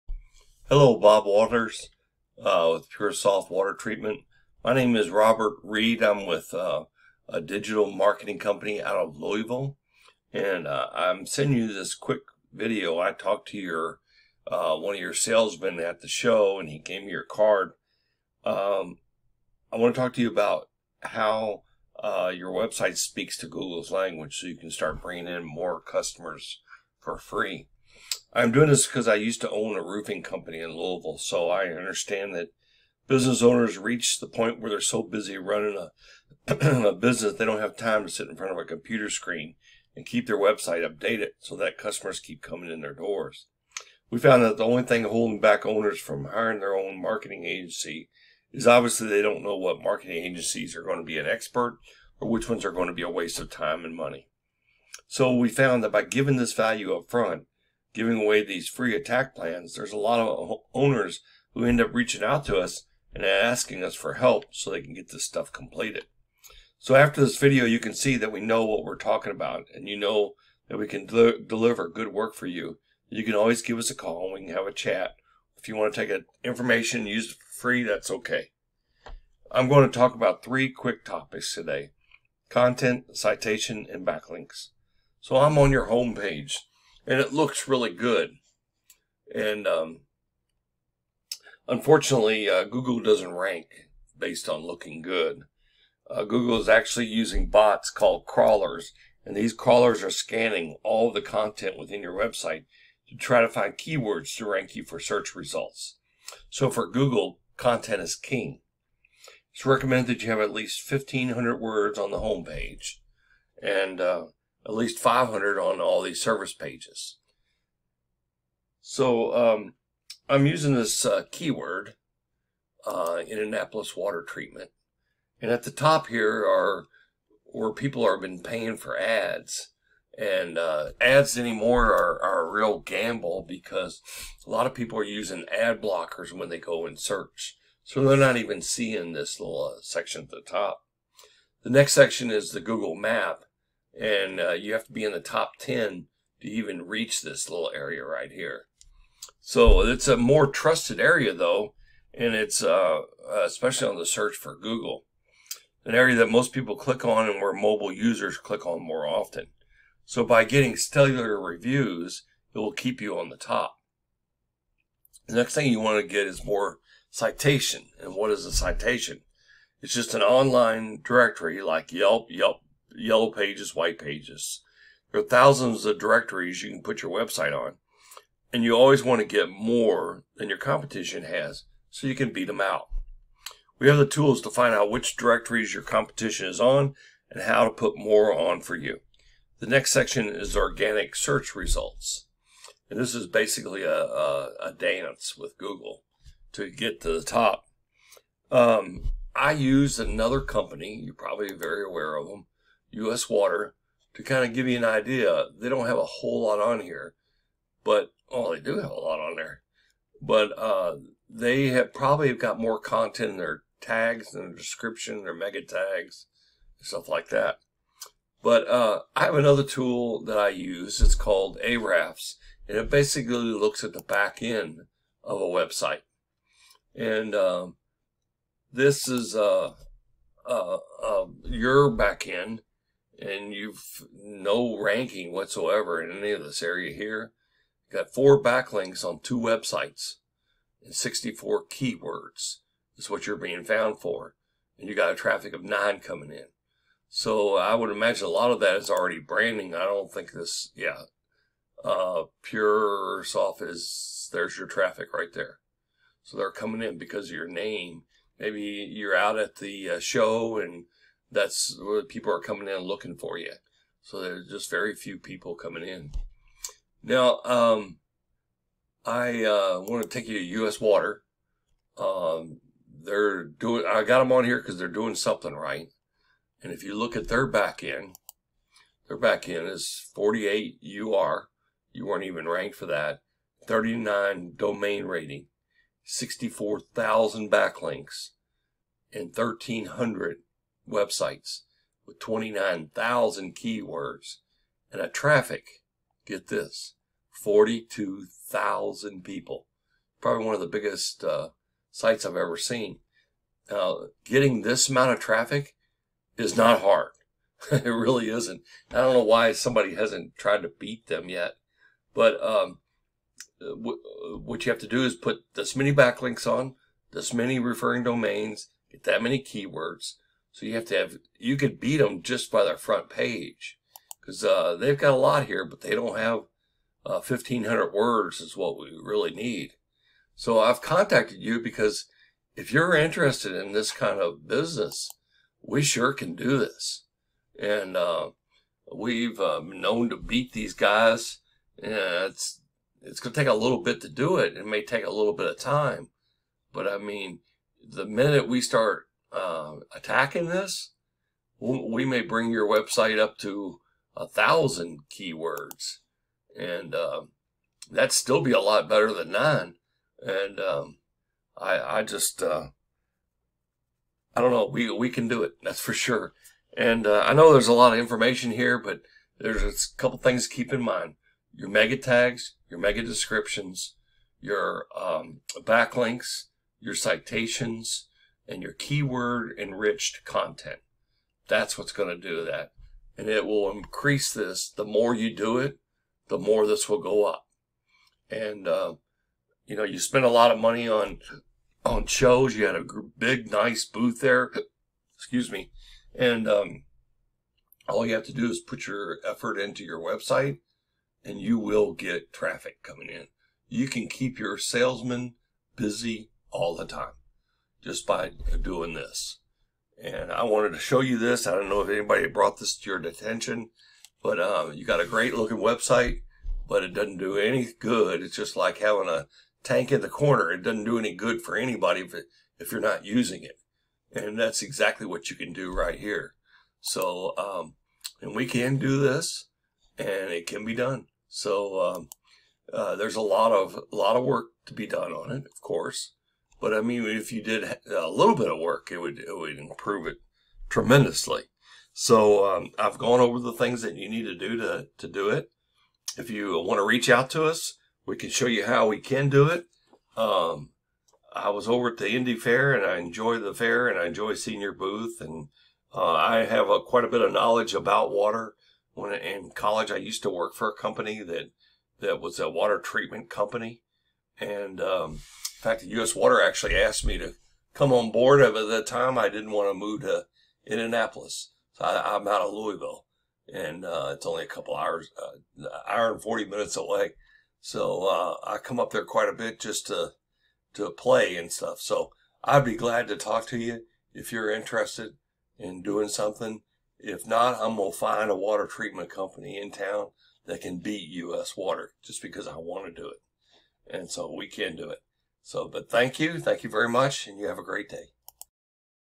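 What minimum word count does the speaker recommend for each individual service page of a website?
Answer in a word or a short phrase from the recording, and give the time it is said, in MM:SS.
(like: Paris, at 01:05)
500, at 01:54.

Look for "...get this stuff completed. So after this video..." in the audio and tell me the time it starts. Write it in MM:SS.
01:04.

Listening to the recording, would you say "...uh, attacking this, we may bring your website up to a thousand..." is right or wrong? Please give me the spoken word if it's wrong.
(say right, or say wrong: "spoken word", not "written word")
right.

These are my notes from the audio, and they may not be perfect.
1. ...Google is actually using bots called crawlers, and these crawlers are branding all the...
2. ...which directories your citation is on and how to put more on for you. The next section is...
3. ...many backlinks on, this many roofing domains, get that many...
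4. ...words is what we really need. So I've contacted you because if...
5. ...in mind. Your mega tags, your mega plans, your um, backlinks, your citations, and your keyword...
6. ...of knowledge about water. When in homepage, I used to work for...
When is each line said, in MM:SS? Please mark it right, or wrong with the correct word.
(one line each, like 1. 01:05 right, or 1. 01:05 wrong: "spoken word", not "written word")
1. 01:36 wrong: "scanning", not "branding"
2. 03:04 wrong: "competition", not "citation"
3. 05:15 wrong: "referring", not "roofing"
4. 05:27 right
5. 06:10 wrong: "descriptions", not "plans"
6. 07:37 wrong: "college", not "homepage".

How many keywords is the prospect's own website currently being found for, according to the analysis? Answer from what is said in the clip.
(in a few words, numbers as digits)
64.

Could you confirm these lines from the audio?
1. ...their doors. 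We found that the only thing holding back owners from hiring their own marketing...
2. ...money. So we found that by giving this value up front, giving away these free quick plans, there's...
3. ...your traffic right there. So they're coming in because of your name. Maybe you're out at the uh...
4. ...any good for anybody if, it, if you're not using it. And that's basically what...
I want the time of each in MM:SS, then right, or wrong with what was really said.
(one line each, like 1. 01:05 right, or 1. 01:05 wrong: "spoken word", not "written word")
1. 00:42 right
2. 00:53 wrong: "attack", not "quick"
3. 04:14 right
4. 07:00 wrong: "exactly", not "basically".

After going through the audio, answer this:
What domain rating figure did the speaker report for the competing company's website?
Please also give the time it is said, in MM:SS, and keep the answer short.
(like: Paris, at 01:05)
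39, at 04:43.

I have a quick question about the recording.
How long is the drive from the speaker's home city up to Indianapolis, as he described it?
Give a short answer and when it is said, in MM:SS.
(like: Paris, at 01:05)
1 hour 40 minutes, at 07:55.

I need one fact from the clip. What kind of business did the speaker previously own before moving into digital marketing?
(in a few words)
Roofing company.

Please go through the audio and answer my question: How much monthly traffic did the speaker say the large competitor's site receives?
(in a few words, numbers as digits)
42,000.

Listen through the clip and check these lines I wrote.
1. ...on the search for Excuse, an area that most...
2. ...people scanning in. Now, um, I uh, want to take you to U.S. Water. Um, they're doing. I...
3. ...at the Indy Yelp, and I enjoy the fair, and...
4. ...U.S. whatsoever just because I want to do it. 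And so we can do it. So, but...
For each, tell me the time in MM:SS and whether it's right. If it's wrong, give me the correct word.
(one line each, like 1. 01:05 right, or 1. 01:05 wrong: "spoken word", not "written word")
1. 02:33 wrong: "Google", not "Excuse"
2. 04:25 wrong: "coming", not "scanning"
3. 07:31 wrong: "Fair", not "Yelp"
4. 08:11 wrong: "water", not "whatsoever".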